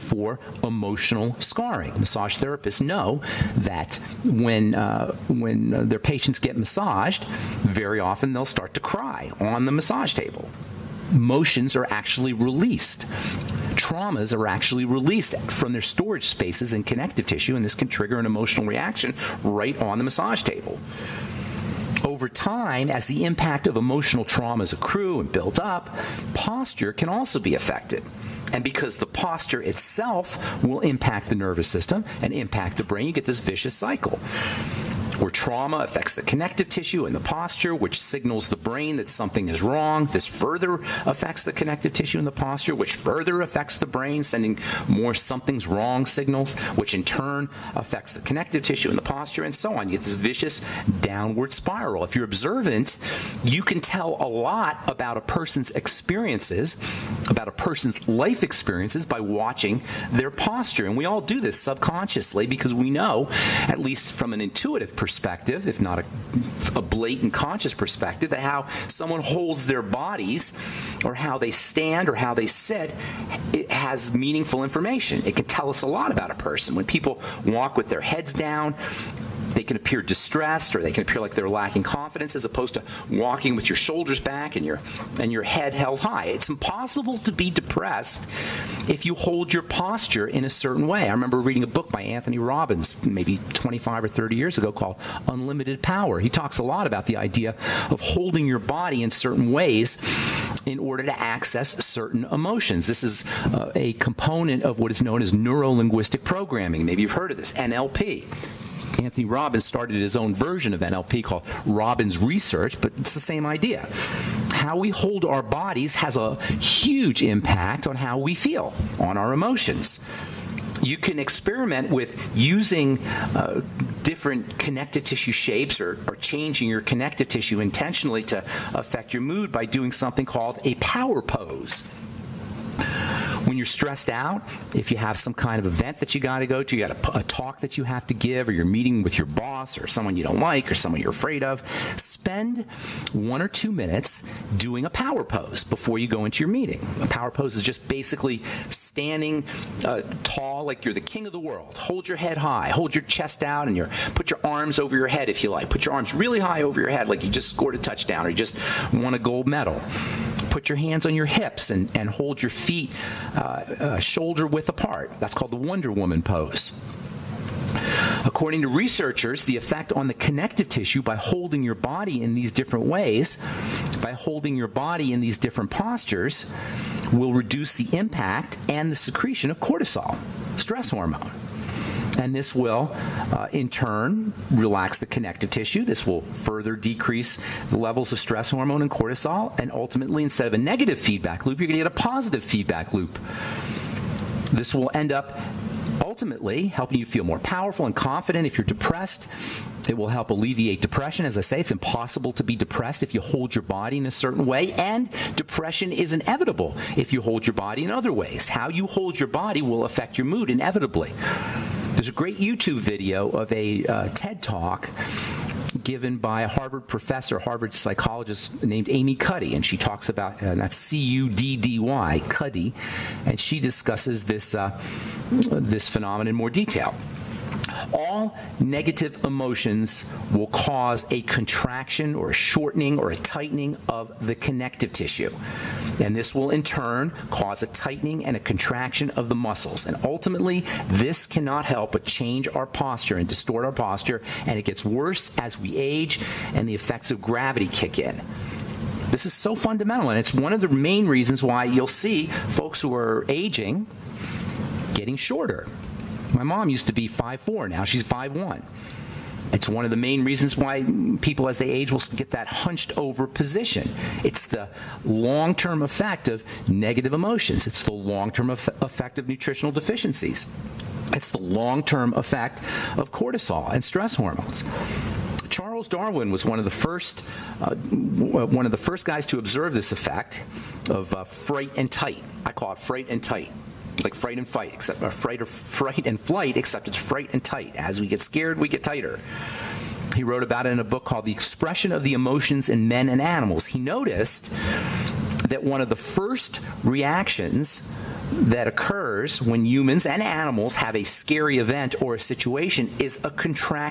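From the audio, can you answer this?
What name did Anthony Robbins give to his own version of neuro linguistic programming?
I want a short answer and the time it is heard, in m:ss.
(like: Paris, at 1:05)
Robbins Research, at 1:51.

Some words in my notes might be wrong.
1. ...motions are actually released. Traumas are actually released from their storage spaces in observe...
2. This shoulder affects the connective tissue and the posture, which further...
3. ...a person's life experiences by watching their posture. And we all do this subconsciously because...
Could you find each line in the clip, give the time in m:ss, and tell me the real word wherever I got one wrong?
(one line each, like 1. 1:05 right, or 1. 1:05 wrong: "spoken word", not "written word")
1. 0:11 wrong: "connective", not "observe"
2. 0:40 wrong: "further", not "shoulder"
3. 0:57 right.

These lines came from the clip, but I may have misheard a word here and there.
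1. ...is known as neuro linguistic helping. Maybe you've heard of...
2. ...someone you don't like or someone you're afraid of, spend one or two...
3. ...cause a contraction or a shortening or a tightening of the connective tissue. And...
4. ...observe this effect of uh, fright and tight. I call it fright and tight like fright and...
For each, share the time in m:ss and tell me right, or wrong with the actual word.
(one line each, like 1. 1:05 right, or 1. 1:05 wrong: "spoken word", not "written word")
1. 1:44 wrong: "programming", not "helping"
2. 2:19 right
3. 3:50 right
4. 4:39 right.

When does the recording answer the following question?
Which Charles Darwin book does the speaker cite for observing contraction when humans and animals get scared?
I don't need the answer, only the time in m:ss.
4:51.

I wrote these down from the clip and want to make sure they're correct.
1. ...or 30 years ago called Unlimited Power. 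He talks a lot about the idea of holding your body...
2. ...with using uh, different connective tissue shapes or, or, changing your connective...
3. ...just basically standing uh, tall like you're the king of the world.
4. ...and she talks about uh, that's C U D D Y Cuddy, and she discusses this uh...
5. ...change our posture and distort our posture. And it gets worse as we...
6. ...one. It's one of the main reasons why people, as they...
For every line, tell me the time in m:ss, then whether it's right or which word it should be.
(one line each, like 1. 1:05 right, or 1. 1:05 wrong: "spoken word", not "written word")
1. 1:34 right
2. 2:01 right
3. 2:27 right
4. 3:39 right
5. 4:02 right
6. 4:18 right.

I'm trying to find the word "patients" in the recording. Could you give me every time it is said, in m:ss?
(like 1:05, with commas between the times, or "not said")
0:06.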